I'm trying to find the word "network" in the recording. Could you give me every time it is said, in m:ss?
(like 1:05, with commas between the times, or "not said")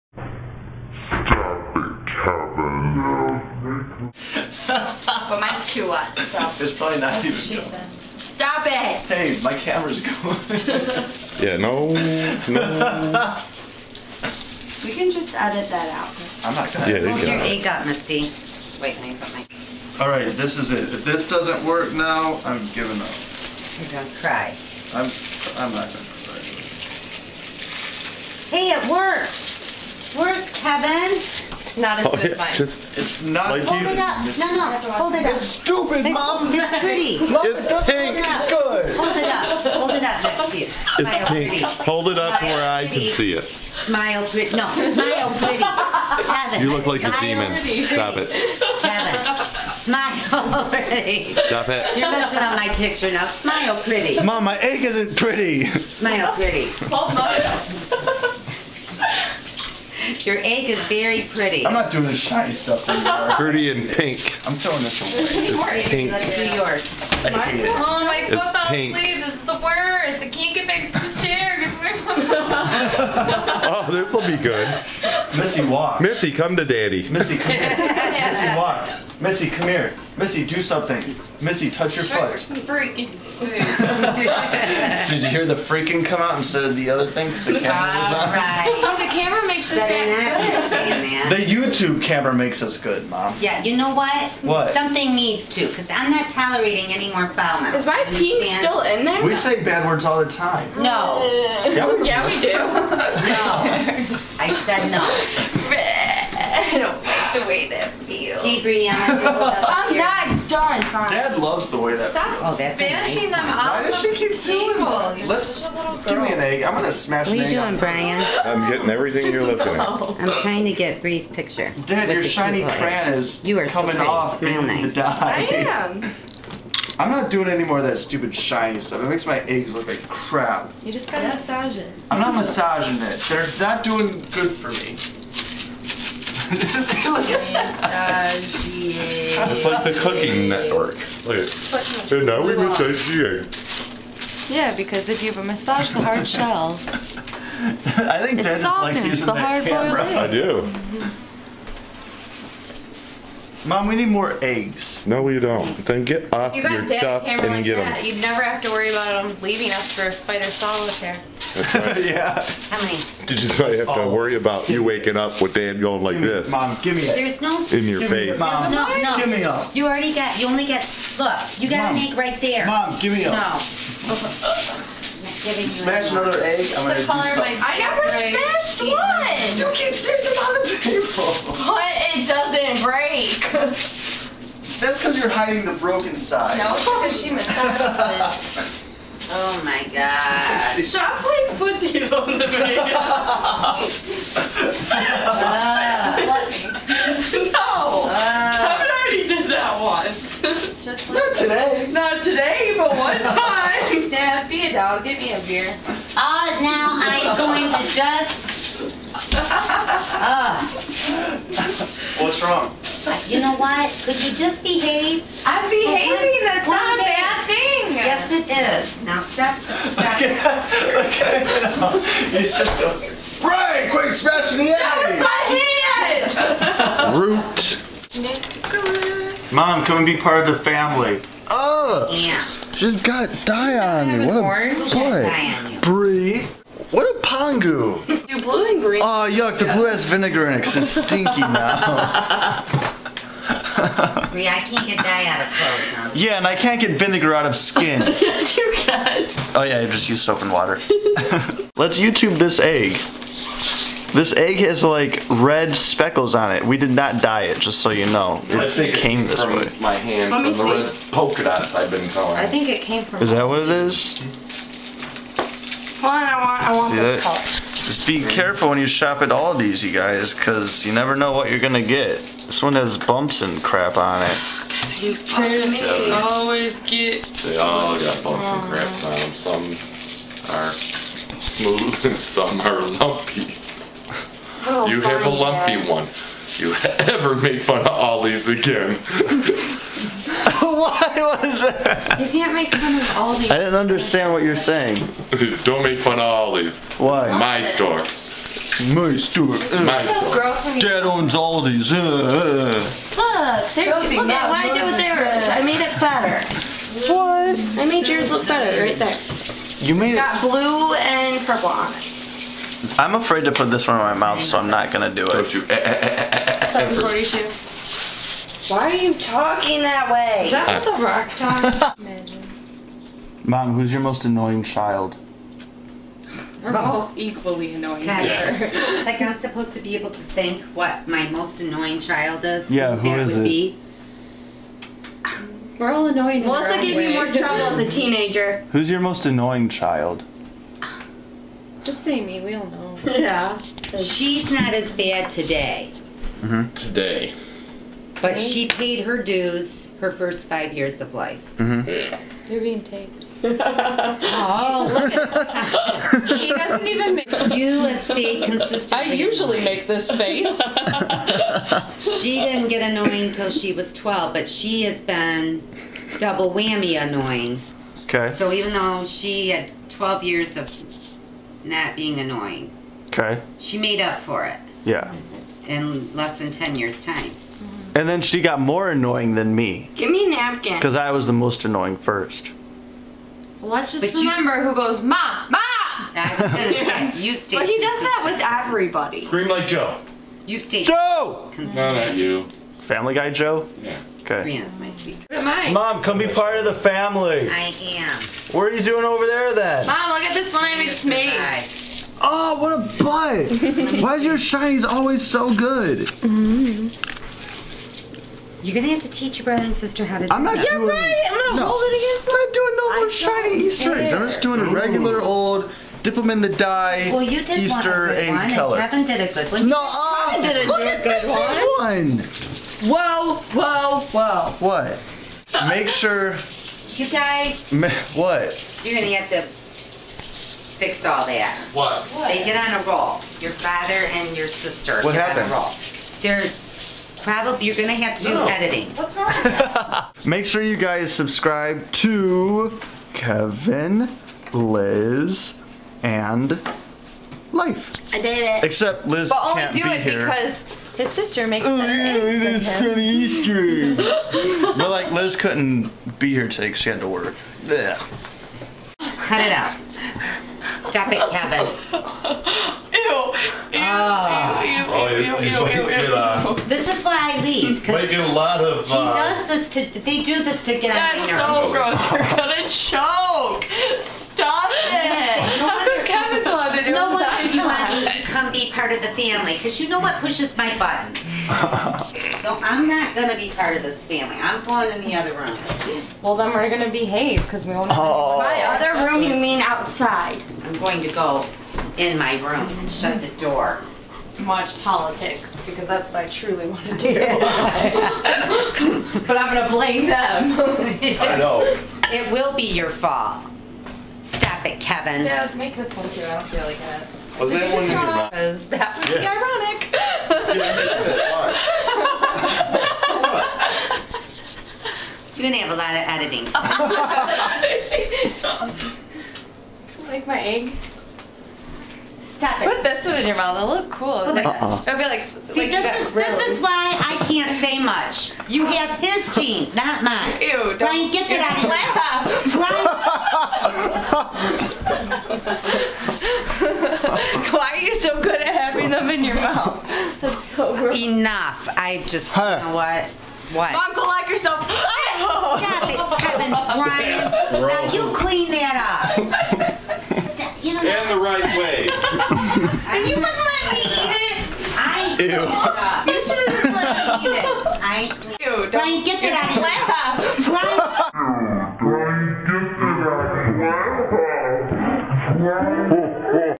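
2:20.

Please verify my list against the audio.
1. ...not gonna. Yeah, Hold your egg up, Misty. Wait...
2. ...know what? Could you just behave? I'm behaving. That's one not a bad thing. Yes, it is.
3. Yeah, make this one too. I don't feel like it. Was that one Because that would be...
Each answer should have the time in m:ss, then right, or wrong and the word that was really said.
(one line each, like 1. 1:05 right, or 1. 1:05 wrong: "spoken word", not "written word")
1. 0:16 right
2. 3:33 right
3. 8:25 right.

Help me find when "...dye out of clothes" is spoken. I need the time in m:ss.
4:04.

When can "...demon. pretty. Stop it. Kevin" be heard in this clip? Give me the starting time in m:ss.
0:47.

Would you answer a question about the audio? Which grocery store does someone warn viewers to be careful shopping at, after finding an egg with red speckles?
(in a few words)
Aldi's.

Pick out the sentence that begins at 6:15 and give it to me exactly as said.
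in less than 10 years' time.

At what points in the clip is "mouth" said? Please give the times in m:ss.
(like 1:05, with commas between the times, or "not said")
1:37, 5:14, 8:43.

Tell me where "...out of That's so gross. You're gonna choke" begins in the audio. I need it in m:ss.
7:50.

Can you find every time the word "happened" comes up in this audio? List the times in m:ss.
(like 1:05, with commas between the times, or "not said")
7:15.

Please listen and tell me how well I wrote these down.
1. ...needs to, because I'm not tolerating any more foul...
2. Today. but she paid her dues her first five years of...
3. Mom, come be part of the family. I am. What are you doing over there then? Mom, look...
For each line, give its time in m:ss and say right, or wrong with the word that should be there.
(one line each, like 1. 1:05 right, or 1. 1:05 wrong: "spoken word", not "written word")
1. 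1:35 right
2. 5:46 right
3. 6:35 right.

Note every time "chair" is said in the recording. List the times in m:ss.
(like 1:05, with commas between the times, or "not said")
1:11.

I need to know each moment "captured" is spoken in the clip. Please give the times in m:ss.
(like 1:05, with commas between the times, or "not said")
not said.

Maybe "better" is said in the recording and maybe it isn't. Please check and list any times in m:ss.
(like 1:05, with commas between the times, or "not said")
1:29, 5:08, 7:31.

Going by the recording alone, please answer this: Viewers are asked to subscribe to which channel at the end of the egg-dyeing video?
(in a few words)
Kevin, Liz, and life.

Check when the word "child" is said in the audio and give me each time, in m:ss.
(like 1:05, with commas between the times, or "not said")
5:24, 5:31, 5:39.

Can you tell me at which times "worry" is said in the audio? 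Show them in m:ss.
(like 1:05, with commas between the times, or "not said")
2:38, 2:44.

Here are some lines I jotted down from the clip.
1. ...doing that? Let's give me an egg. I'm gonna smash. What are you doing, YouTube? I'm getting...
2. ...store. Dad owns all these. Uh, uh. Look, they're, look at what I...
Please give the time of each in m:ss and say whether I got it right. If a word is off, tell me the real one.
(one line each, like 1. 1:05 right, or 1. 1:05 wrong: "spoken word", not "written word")
1. 1:54 wrong: "Brian", not "YouTube"
2. 5:00 right.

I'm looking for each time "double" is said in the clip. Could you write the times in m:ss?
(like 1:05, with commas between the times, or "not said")
6:06.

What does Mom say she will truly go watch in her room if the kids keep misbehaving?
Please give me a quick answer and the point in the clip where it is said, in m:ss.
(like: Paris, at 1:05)
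Politics, at 8:14.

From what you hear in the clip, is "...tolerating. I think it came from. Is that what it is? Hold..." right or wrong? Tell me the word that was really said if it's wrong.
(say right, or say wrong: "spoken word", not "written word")
wrong: "coloring", not "tolerating".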